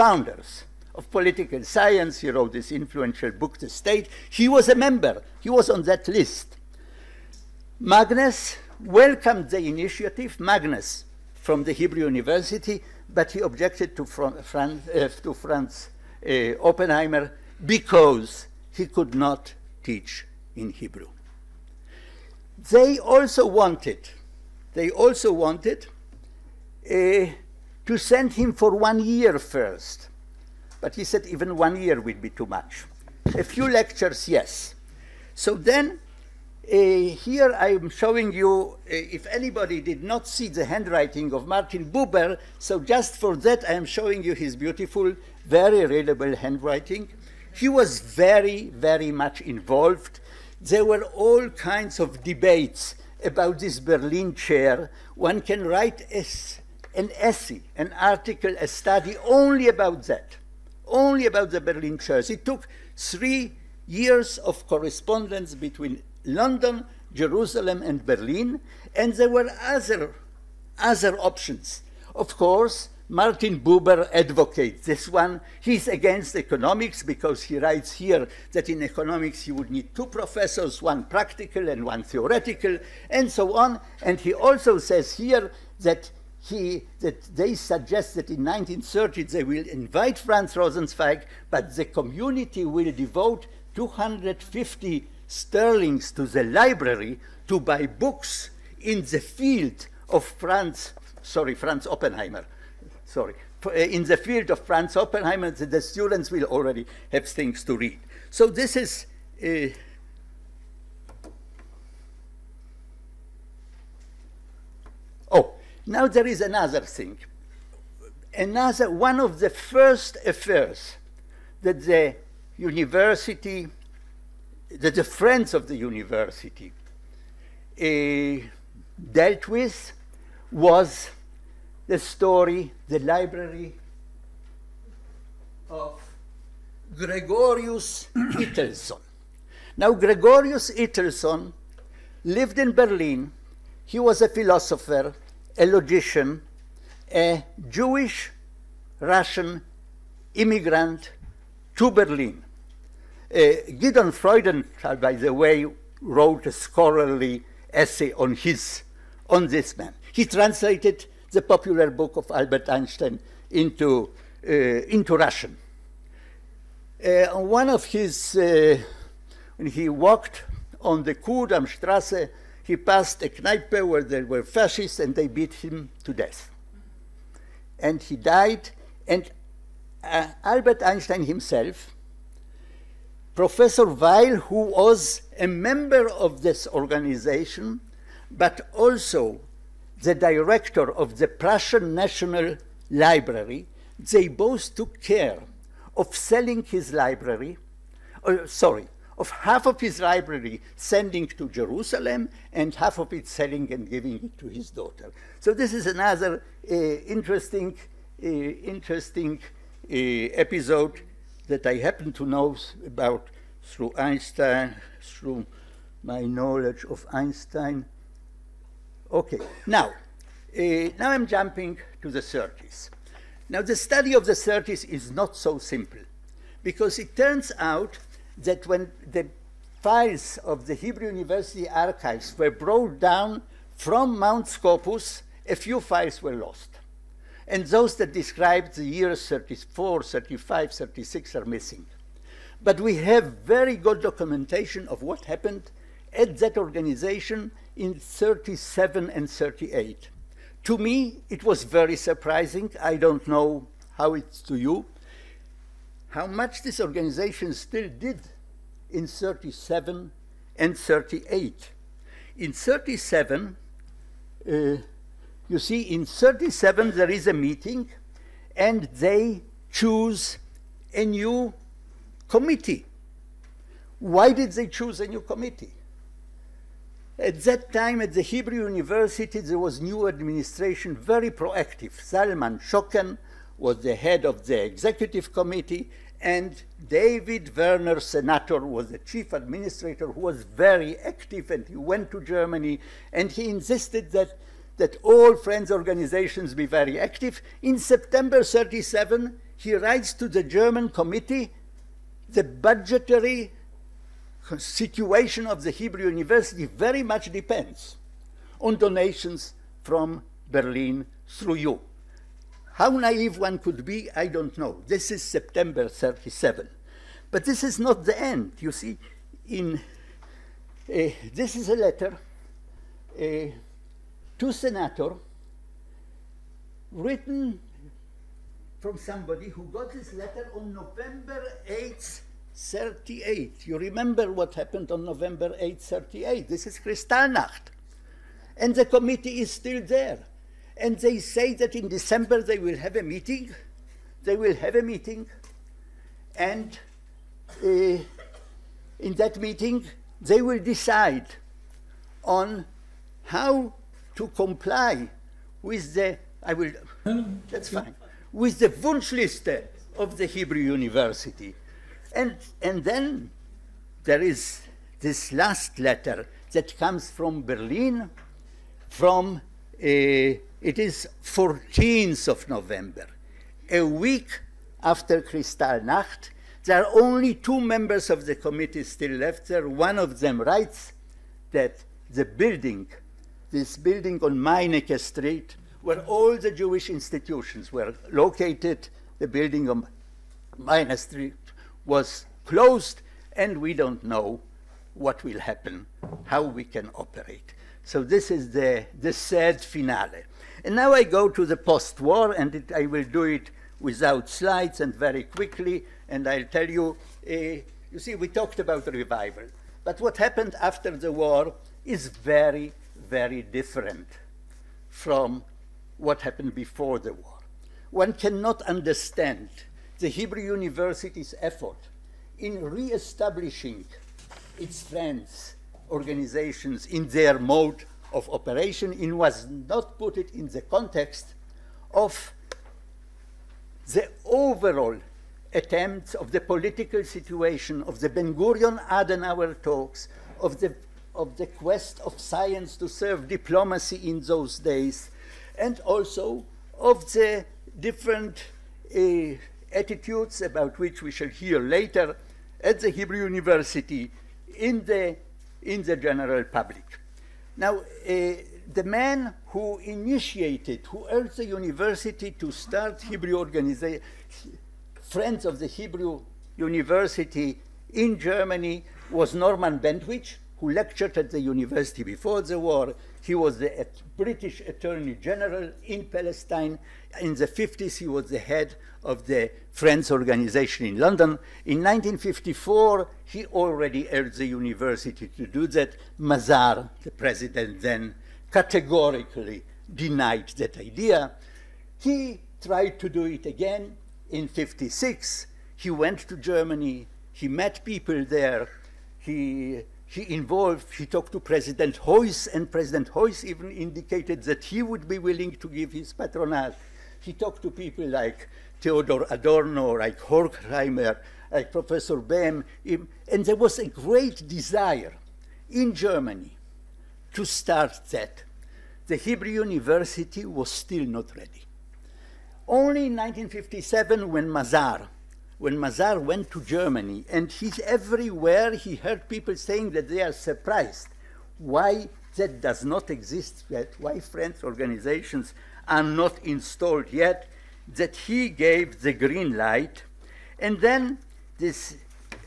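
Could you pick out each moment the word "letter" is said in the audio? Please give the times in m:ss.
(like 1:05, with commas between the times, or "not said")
5:21, 5:30, 6:05.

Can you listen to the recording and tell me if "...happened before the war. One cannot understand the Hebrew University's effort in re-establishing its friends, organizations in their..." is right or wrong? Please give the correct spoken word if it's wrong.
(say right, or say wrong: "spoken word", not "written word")
right.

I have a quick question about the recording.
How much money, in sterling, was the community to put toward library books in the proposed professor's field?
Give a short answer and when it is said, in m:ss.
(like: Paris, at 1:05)
250, at 1:33.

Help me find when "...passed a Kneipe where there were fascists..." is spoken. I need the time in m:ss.
2:52.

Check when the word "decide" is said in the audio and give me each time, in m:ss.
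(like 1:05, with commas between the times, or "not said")
5:50.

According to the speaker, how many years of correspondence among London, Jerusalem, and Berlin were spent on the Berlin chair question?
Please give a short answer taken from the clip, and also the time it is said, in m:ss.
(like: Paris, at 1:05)
3, at 1:02.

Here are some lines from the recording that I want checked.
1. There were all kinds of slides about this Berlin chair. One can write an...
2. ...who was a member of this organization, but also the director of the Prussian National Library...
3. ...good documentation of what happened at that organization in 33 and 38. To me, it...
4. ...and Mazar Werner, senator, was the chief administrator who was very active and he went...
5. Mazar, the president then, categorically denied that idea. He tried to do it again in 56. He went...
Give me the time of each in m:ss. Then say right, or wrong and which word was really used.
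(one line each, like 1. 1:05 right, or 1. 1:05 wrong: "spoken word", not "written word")
1. 0:50 wrong: "debates", not "slides"
2. 3:04 right
3. 4:03 wrong: "37", not "33"
4. 4:46 wrong: "David", not "Mazar"
5. 8:06 right.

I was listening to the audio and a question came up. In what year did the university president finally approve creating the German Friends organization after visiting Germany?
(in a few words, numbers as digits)
1957.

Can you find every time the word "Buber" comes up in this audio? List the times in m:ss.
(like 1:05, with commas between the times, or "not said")
0:41, 1:13.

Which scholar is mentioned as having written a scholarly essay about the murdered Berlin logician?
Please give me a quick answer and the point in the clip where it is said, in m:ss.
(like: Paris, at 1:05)
Gideon Freudenthal, at 2:33.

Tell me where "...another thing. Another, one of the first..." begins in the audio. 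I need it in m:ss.
1:56.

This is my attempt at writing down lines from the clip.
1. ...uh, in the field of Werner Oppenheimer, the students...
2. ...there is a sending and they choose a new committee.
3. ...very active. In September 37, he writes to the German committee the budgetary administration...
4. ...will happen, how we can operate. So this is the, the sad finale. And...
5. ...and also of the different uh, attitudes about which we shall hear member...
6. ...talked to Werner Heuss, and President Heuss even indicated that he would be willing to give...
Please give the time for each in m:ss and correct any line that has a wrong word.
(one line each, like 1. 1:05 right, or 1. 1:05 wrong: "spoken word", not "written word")
1. 1:43 wrong: "Franz", not "Werner"
2. 4:26 wrong: "meeting", not "sending"
3. 4:56 wrong: "situation", not "administration"
4. 6:35 right
5. 7:25 wrong: "later", not "member"
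6. 8:21 wrong: "President", not "Werner".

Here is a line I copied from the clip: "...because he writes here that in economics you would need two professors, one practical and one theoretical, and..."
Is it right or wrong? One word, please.
right.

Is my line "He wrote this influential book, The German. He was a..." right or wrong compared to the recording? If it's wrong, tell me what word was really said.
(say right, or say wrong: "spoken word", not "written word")
wrong: "State", not "German".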